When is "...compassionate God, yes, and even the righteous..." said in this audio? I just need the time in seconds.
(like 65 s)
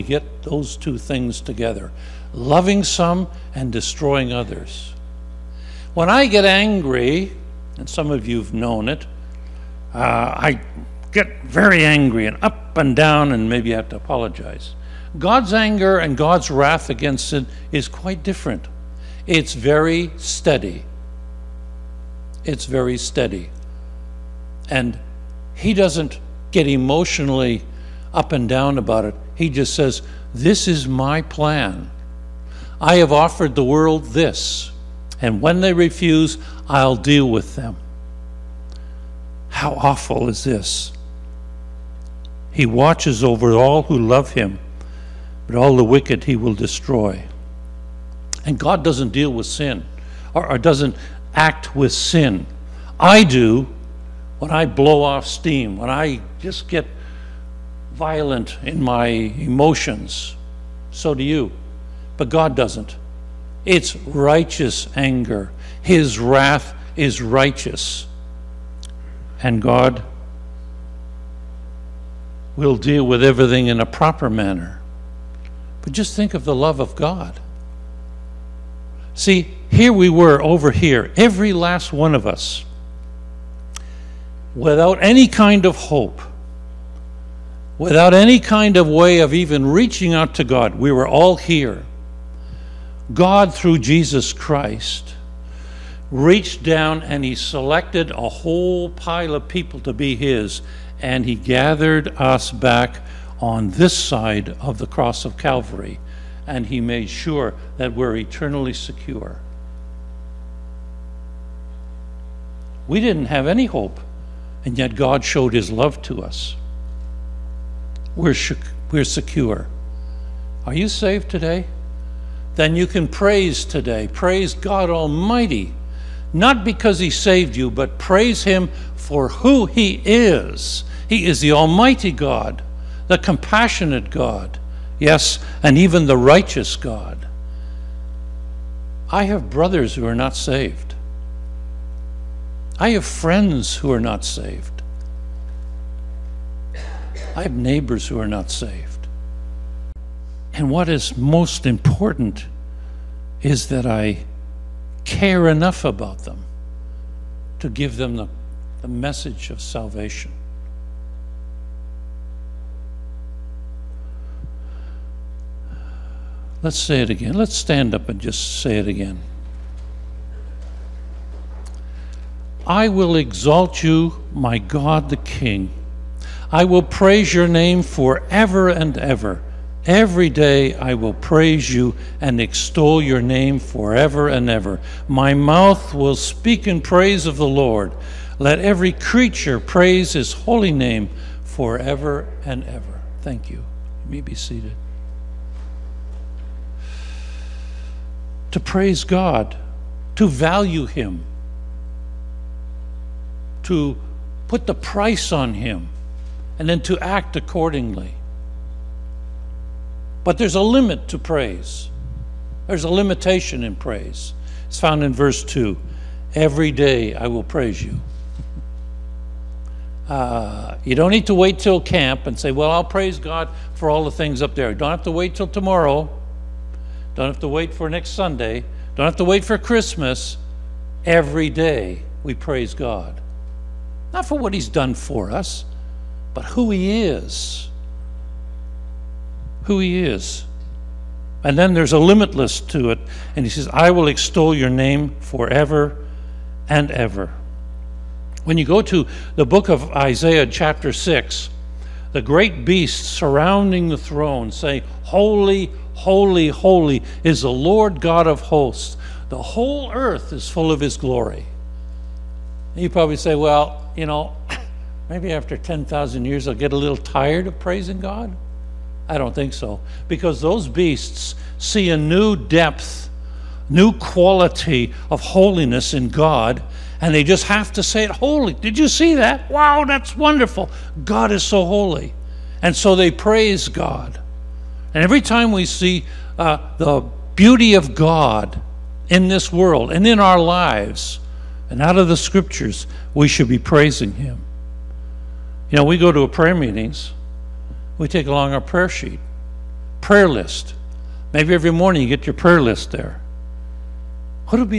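133 s.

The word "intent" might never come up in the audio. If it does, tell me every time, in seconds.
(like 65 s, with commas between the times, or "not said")
not said.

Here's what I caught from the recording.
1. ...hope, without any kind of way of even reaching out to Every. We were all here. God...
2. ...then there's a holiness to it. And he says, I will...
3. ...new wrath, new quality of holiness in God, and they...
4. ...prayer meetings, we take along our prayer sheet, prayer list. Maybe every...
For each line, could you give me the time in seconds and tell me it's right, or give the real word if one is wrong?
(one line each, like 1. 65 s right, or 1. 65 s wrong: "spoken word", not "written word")
1. 85 s wrong: "God", not "Every"
2. 241 s wrong: "limitless", not "holiness"
3. 271 s wrong: "depth", not "wrath"
4. 296 s right.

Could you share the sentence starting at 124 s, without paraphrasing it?
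Praise God Almighty, not because he saved you, but praise him for who he is.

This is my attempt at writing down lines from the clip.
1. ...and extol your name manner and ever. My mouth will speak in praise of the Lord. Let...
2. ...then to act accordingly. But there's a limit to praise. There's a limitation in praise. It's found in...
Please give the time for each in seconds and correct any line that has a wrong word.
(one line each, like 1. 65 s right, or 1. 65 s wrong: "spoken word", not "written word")
1. 182 s wrong: "forever", not "manner"
2. 206 s right.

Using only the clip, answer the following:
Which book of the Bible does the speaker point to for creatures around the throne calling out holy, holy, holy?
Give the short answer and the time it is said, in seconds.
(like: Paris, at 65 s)
Isaiah, at 249 s.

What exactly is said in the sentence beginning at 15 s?
God's anger and God's wrath against sin is quite different.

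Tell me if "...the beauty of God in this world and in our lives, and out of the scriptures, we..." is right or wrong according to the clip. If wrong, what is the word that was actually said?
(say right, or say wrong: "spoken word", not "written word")
right.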